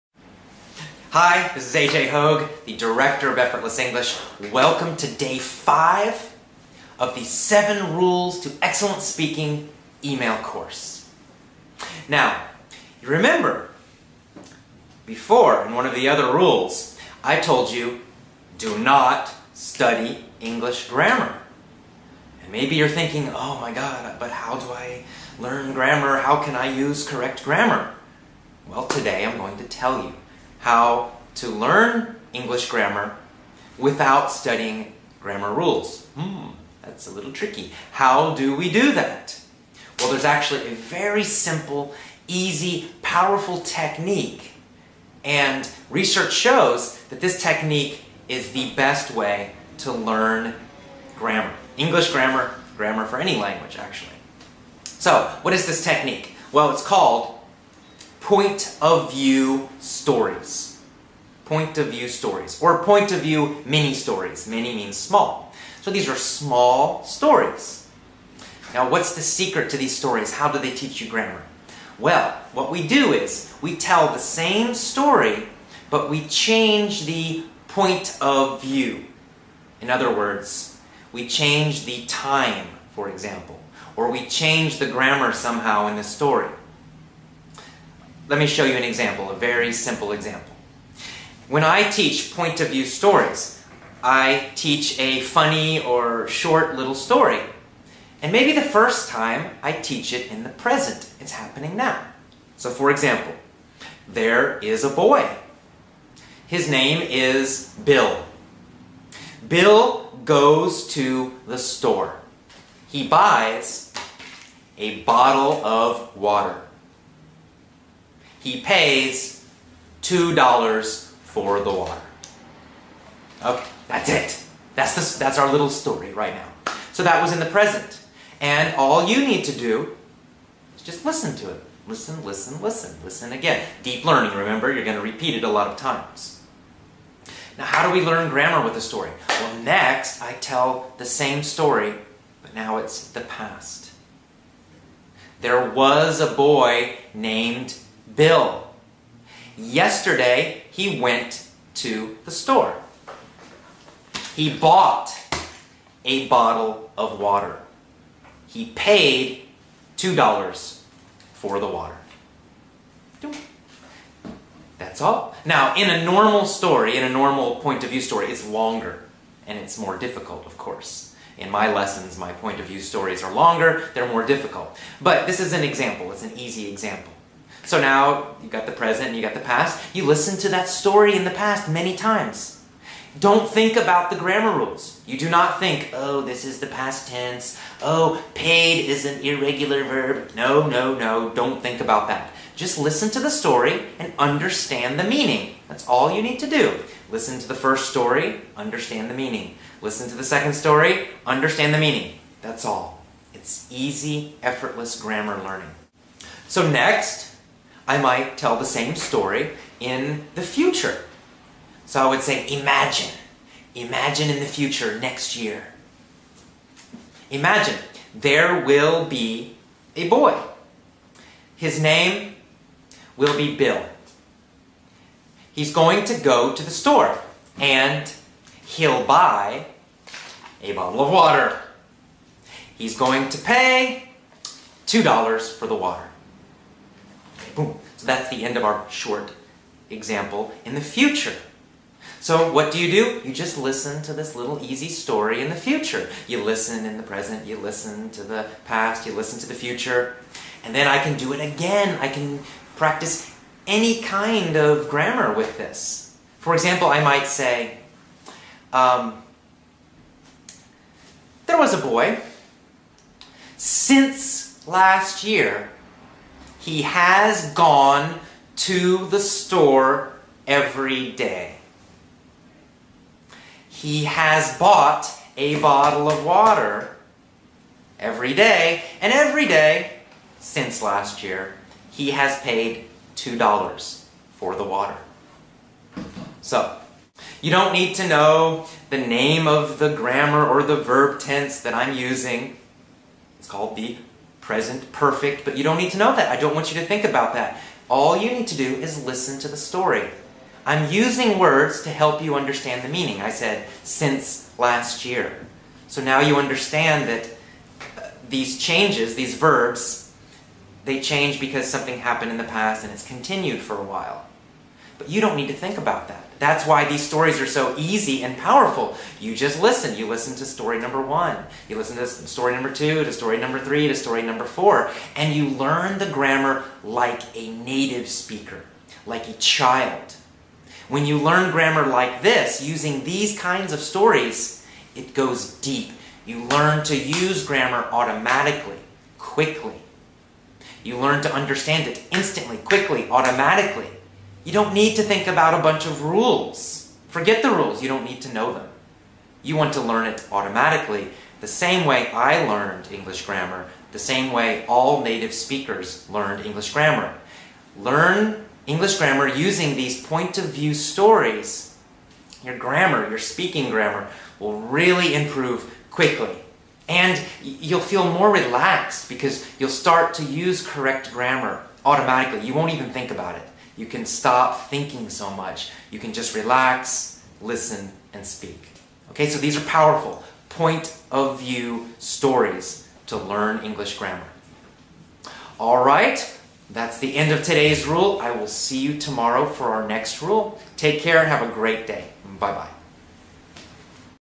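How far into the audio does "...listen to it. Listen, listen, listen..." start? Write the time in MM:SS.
02:11.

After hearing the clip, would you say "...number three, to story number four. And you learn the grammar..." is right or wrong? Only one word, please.
right.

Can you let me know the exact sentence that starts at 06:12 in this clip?
You won't even think about it.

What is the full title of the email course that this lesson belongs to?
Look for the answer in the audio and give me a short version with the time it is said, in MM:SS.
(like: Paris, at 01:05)
Seven Rules to Excellent Speaking, at 00:07.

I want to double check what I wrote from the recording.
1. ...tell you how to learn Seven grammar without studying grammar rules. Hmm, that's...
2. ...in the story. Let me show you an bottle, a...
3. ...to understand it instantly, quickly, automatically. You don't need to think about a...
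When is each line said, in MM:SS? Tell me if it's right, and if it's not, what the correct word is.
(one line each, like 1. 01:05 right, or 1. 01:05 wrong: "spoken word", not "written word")
1. 00:29 wrong: "English", not "Seven"
2. 01:25 wrong: "example", not "bottle"
3. 05:41 right.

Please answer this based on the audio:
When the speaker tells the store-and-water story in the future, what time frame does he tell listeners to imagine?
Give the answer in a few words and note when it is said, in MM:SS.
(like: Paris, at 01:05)
next year, at 03:34.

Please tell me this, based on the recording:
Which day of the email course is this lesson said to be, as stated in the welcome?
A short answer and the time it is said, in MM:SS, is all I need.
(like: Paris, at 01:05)
Day 5, at 00:05.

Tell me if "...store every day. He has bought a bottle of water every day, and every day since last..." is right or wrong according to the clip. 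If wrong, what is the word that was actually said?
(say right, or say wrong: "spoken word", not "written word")
right.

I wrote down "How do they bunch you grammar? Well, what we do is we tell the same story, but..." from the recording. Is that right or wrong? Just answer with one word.
wrong.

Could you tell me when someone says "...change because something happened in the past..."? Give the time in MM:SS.
05:10.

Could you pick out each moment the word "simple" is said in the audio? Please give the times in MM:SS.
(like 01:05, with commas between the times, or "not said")
00:41, 01:29.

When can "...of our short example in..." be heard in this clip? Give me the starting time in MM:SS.
03:58.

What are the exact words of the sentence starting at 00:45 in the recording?
And research shows that this technique is the best way to learn grammar.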